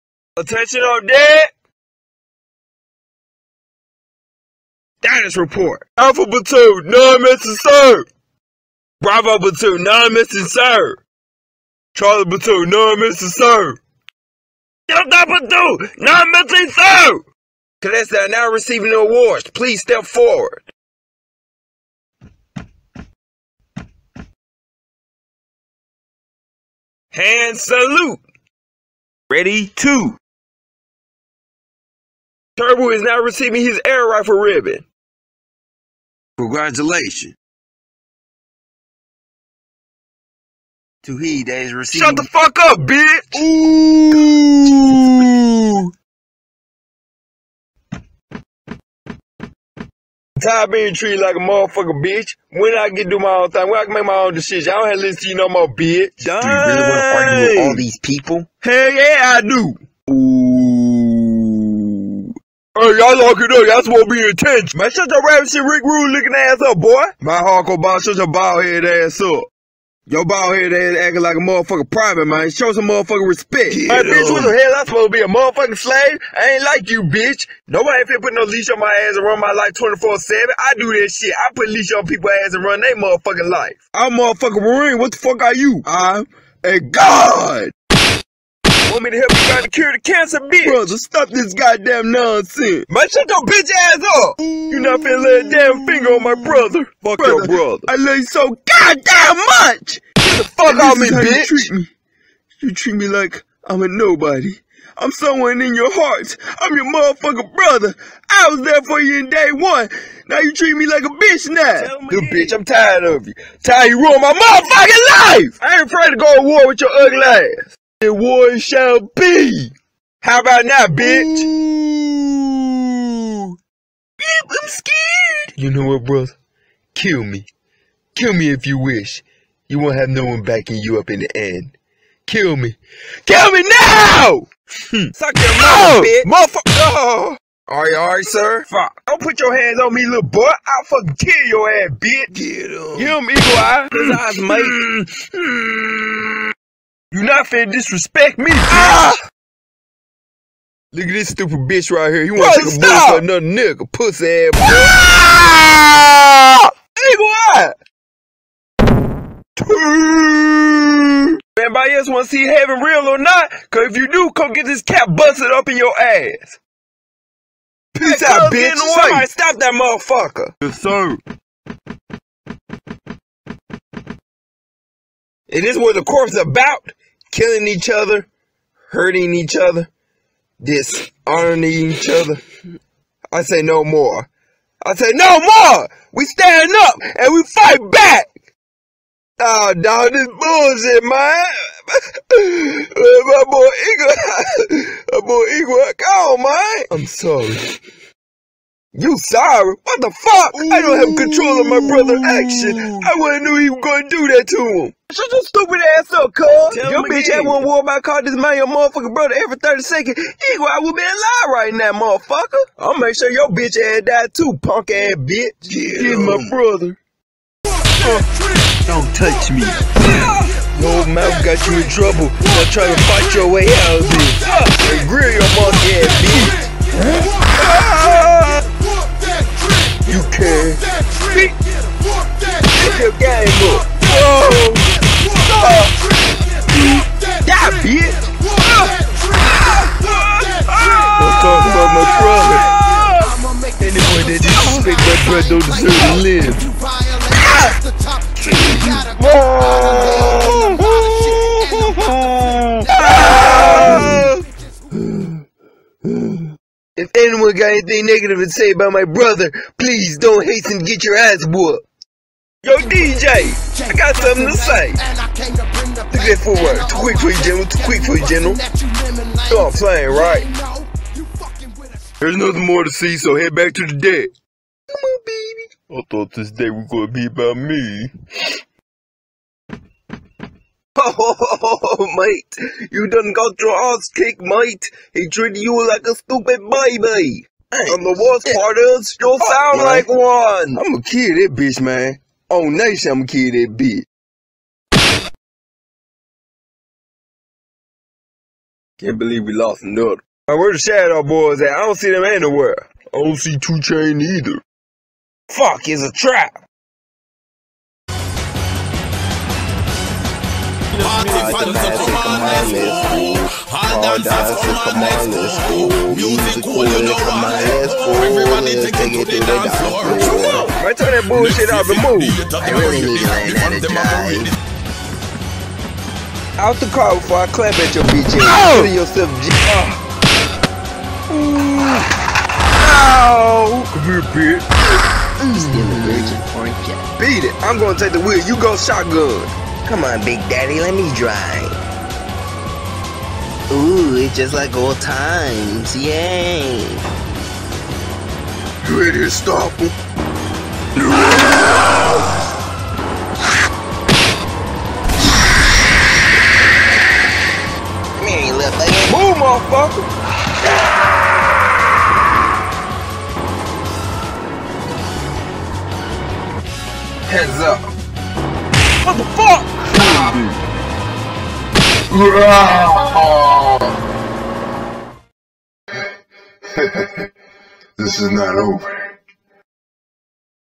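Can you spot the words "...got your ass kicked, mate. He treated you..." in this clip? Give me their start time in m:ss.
4:43.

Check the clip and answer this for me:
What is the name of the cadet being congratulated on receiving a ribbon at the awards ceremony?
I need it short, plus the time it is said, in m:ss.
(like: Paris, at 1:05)
Turbo, at 0:32.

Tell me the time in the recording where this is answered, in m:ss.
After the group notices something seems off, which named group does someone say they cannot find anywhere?
5:00.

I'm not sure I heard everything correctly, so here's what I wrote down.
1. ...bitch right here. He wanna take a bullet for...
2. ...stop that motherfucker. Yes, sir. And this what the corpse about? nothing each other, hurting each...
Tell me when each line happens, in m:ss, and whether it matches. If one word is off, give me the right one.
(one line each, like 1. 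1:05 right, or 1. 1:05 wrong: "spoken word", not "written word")
1. 2:31 right
2. 2:49 wrong: "killing", not "nothing".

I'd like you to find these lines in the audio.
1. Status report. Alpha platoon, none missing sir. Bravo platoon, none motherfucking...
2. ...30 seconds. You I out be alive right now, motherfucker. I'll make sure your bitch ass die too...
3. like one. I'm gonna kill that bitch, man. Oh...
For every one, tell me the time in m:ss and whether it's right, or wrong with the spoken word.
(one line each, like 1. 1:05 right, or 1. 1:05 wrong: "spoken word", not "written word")
1. 0:05 wrong: "missing", not "motherfucking"
2. 3:29 right
3. 4:49 right.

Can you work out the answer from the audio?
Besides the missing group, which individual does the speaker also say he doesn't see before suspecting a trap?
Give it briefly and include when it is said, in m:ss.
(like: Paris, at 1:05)
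Two Chain, at 5:03.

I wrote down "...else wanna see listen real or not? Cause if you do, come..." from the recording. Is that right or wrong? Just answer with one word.
wrong.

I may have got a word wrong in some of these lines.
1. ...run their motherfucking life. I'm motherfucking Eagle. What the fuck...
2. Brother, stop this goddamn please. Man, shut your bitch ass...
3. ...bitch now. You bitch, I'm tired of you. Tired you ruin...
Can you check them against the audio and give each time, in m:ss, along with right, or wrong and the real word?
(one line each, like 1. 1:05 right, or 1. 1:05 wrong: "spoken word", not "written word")
1. 1:22 wrong: "Marine", not "Eagle"
2. 1:30 wrong: "nonsense", not "please"
3. 1:51 right.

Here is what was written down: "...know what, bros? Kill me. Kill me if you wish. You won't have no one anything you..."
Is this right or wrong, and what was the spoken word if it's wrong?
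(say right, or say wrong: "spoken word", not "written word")
wrong: "backing", not "anything".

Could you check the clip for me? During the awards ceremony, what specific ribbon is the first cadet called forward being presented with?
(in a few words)
Air rifle ribbon.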